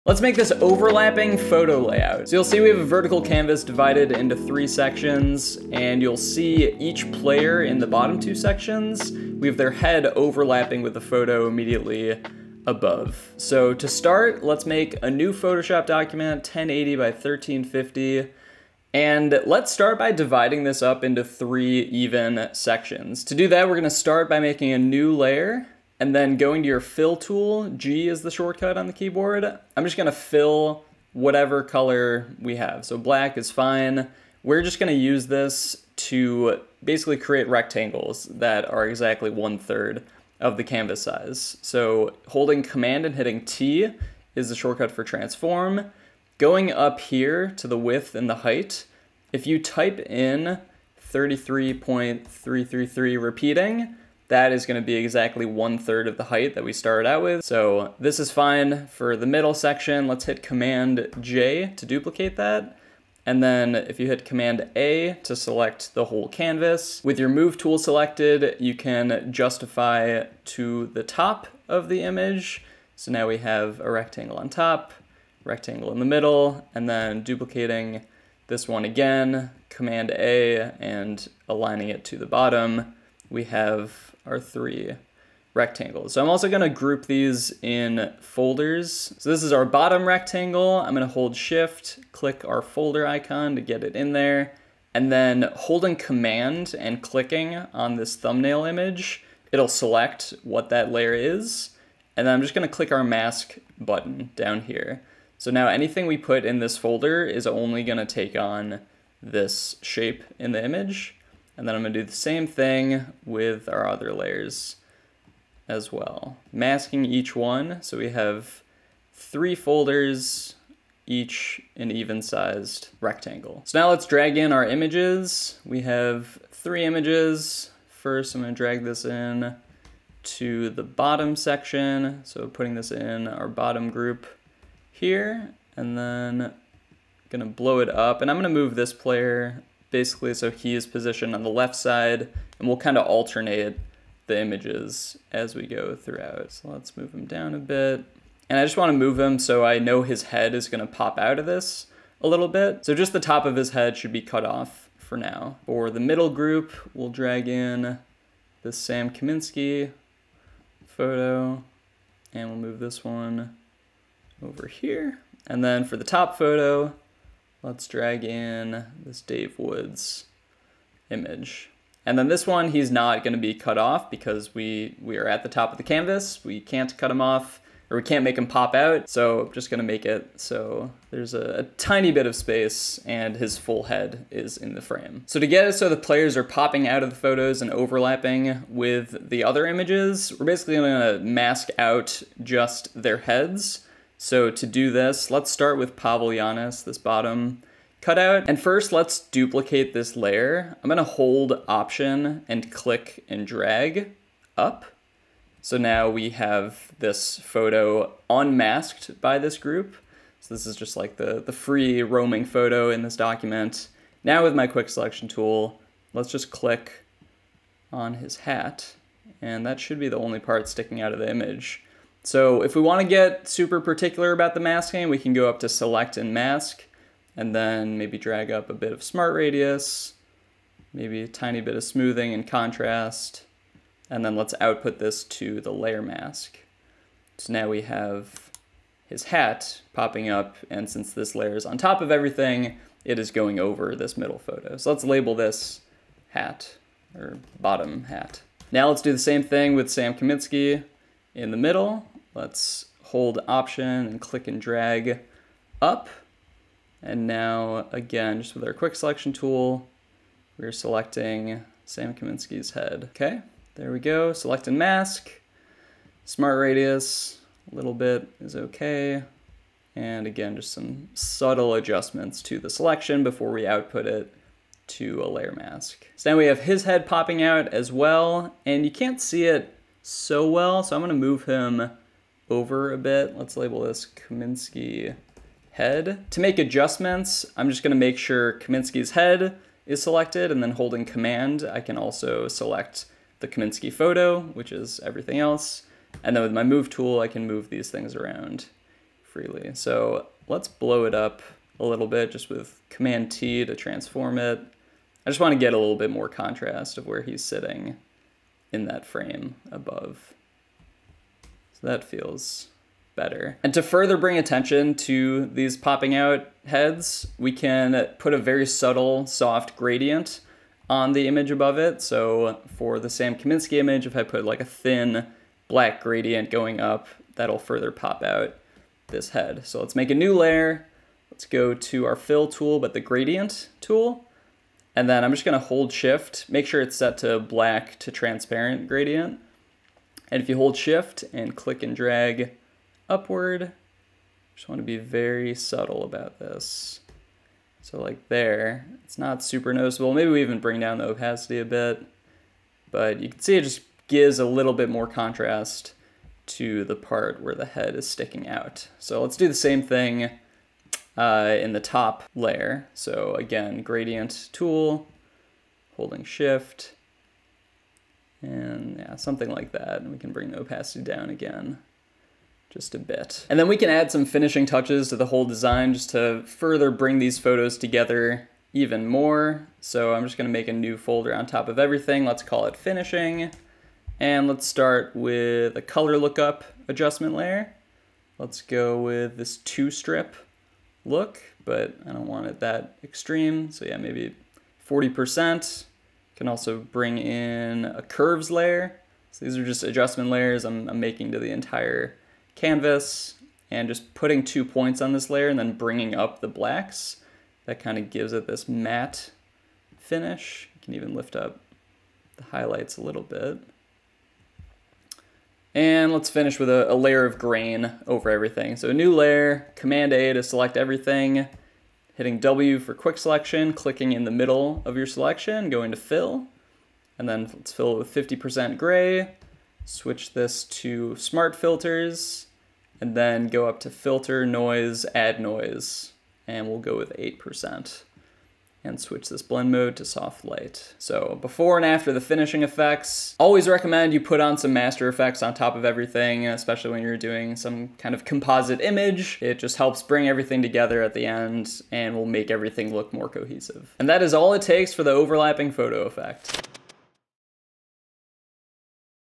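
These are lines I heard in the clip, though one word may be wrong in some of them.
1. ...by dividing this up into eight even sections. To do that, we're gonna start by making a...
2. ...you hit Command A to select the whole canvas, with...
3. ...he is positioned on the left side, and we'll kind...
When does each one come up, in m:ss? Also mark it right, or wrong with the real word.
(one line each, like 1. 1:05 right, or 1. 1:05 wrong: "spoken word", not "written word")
1. 0:19 wrong: "three", not "eight"
2. 1:03 right
3. 2:20 right.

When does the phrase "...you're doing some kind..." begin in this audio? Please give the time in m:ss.
7:27.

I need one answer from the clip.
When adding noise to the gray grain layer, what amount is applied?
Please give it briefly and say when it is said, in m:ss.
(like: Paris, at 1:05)
8%, at 7:17.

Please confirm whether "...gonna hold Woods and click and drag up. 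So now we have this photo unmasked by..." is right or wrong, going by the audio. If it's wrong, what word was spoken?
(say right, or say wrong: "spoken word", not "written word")
wrong: "Option", not "Woods".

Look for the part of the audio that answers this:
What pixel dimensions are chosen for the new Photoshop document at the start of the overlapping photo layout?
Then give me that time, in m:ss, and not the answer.
0:16.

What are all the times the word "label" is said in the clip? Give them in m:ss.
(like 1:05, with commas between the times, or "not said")
4:05, 4:43.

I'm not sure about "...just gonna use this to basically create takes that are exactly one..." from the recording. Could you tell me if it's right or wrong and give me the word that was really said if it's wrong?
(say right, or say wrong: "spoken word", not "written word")
wrong: "rectangles", not "takes".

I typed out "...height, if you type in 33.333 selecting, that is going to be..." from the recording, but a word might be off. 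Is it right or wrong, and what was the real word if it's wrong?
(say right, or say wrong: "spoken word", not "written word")
wrong: "repeating", not "selecting".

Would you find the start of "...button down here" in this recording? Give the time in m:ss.
1:43.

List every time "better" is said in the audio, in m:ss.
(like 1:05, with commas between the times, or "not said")
5:13.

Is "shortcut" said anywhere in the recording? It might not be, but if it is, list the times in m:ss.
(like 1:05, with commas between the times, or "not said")
0:28, 0:44.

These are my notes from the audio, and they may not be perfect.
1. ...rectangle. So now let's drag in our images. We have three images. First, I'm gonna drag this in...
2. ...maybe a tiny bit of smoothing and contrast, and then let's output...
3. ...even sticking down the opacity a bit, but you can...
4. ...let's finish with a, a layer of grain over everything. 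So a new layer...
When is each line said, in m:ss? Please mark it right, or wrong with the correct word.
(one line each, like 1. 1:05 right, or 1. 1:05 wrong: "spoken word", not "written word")
1. 2:02 right
2. 3:50 right
3. 5:50 wrong: "bring", not "sticking"
4. 6:56 right.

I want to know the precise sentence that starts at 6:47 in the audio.
That kind of gives it this matte finish.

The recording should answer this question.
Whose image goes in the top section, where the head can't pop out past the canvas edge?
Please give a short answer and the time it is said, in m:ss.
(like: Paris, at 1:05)
Dave Woods, at 2:49.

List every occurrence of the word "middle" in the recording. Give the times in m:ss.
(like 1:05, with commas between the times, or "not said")
0:59, 1:16, 2:36, 4:04, 4:11, 7:04.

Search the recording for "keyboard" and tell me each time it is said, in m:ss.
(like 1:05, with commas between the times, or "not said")
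0:28.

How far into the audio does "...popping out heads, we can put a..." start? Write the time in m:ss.
5:15.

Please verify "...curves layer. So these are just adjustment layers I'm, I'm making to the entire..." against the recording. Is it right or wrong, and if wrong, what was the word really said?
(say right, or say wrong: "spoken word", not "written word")
right.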